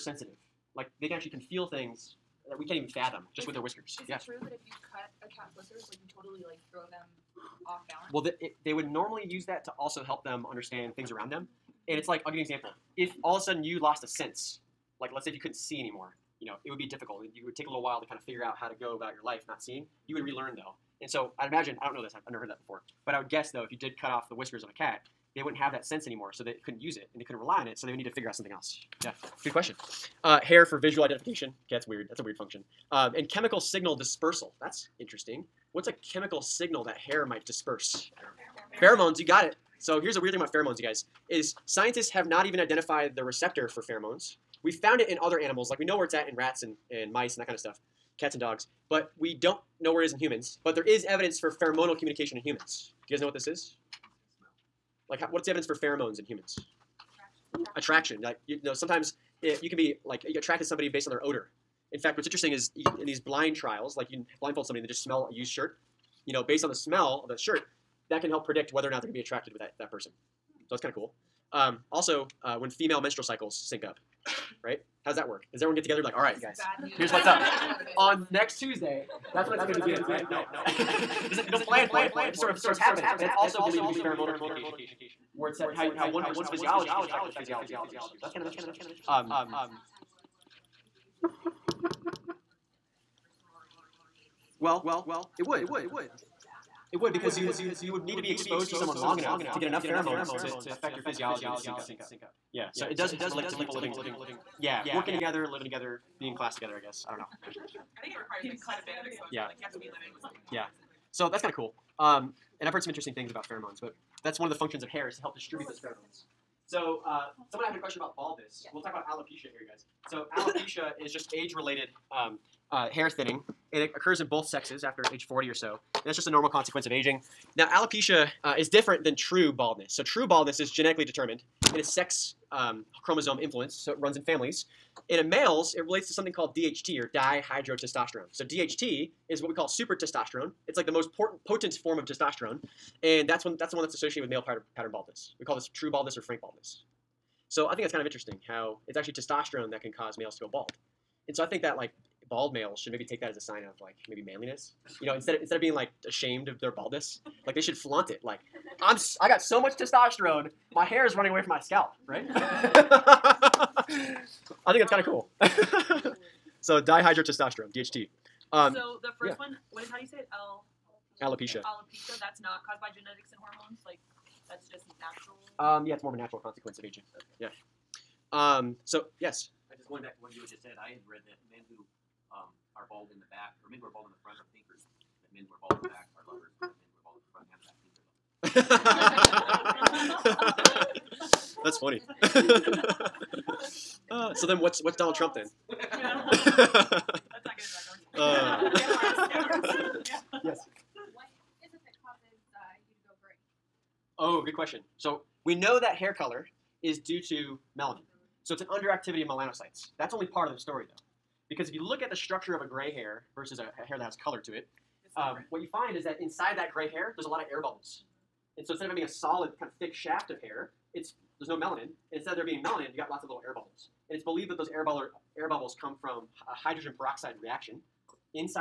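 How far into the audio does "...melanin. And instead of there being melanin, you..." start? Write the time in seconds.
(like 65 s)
221 s.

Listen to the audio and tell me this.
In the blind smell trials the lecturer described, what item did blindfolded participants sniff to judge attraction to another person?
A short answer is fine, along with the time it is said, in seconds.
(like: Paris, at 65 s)
a used shirt, at 65 s.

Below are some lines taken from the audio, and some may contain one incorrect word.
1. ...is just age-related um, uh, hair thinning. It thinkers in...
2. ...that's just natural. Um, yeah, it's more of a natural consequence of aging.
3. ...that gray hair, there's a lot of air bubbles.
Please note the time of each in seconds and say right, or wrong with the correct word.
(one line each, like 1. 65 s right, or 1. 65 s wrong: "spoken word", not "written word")
1. 121 s wrong: "occurs", not "thinkers"
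2. 174 s right
3. 216 s right.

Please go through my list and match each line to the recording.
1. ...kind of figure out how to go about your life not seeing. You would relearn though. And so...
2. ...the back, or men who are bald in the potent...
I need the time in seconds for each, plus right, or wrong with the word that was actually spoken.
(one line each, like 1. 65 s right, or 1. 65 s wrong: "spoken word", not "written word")
1. 18 s right
2. 183 s wrong: "front", not "potent".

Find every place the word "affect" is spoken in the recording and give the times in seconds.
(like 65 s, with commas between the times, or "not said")
87 s, 100 s.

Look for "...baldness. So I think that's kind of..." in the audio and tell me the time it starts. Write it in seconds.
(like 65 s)
146 s.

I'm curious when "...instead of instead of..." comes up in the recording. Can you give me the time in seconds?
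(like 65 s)
155 s.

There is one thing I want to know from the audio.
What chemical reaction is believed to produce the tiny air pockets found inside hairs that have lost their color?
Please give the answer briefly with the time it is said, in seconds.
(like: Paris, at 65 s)
hydrogen peroxide reaction, at 226 s.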